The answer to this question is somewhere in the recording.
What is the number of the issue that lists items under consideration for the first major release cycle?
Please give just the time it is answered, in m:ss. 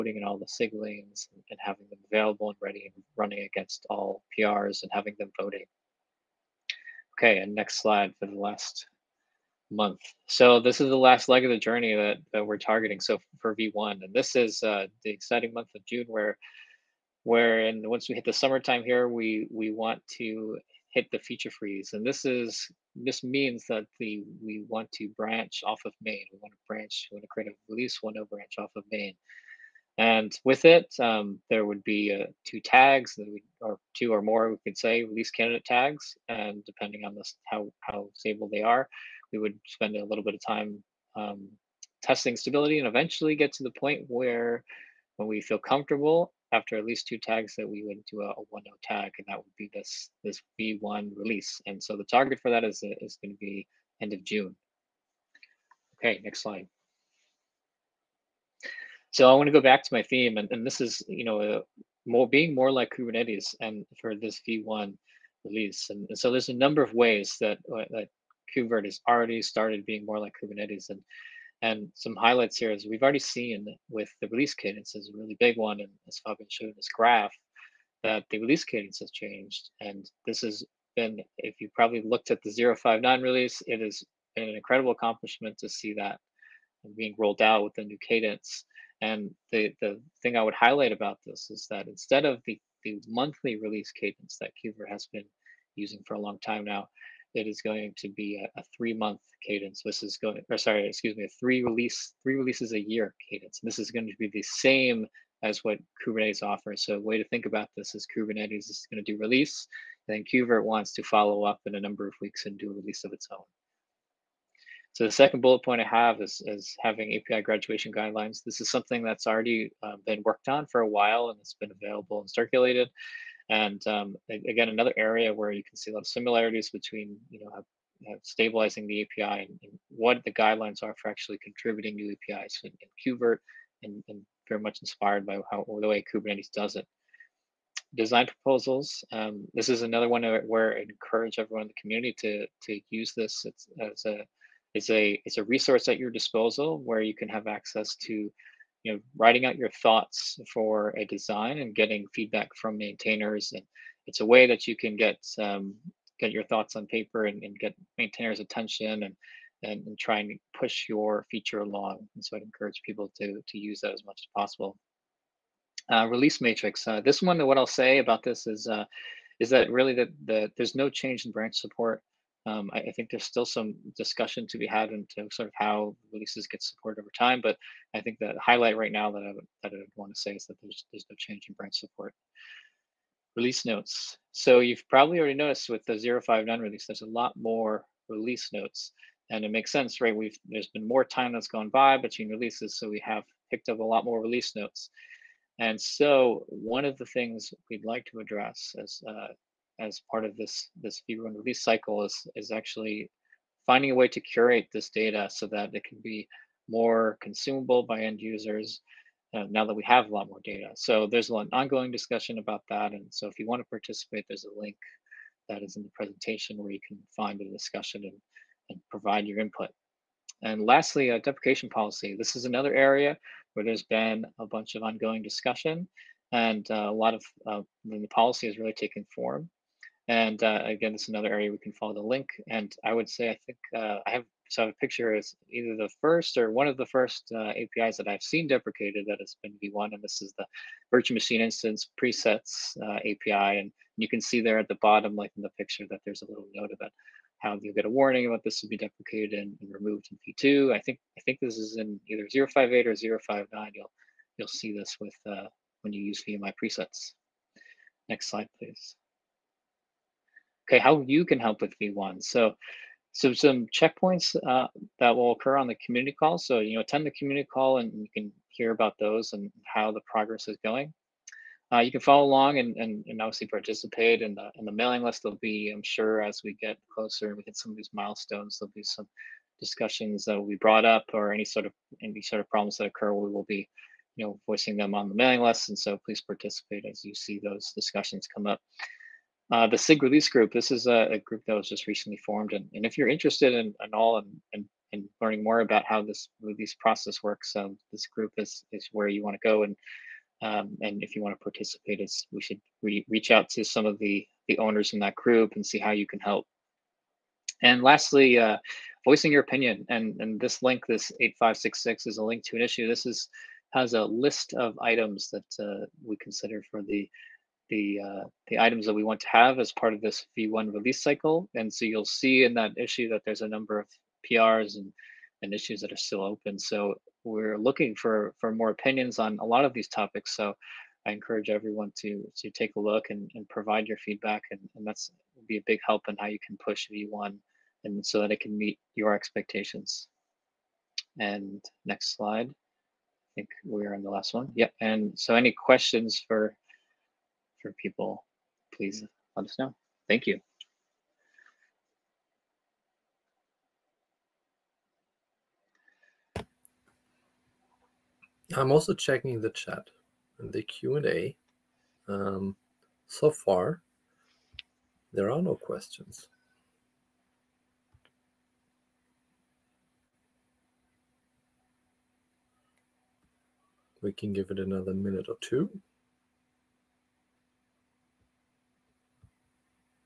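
5:11.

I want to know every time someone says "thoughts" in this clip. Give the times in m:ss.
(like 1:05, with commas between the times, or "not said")
2:29, 2:36.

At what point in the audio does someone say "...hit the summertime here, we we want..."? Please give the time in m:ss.
0:18.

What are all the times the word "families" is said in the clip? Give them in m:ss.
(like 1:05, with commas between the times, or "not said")
not said.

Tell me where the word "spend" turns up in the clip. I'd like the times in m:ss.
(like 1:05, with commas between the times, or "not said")
0:39.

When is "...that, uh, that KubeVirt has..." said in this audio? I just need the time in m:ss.
1:07.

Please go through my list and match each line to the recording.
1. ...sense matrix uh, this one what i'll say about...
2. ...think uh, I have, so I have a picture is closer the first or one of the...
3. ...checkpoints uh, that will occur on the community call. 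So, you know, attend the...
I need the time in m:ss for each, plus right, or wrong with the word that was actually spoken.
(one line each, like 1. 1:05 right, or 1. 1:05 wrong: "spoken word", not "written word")
1. 2:46 wrong: "release", not "sense"
2. 3:53 wrong: "either", not "closer"
3. 4:23 right.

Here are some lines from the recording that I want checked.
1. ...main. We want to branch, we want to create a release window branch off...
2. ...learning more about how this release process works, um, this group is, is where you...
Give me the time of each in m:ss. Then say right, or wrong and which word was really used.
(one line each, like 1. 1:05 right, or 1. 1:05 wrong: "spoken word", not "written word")
1. 0:26 right
2. 4:55 right.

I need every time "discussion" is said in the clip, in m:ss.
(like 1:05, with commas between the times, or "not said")
2:53, 3:31, 3:37, 3:45, 4:39, 4:47.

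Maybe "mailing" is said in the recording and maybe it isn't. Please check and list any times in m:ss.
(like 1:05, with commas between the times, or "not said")
4:34, 4:45.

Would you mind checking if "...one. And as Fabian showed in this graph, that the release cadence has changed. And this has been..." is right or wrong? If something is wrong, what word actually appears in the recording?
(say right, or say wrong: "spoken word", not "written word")
right.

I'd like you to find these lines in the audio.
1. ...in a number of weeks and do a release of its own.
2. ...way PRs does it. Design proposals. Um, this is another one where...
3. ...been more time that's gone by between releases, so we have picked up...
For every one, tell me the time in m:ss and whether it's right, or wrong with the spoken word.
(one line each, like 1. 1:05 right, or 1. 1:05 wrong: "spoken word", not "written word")
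1. 1:51 right
2. 2:15 wrong: "Kubernetes", not "PRs"
3. 3:10 right.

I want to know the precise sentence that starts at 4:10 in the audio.
I think I think this is in either 058 or 059.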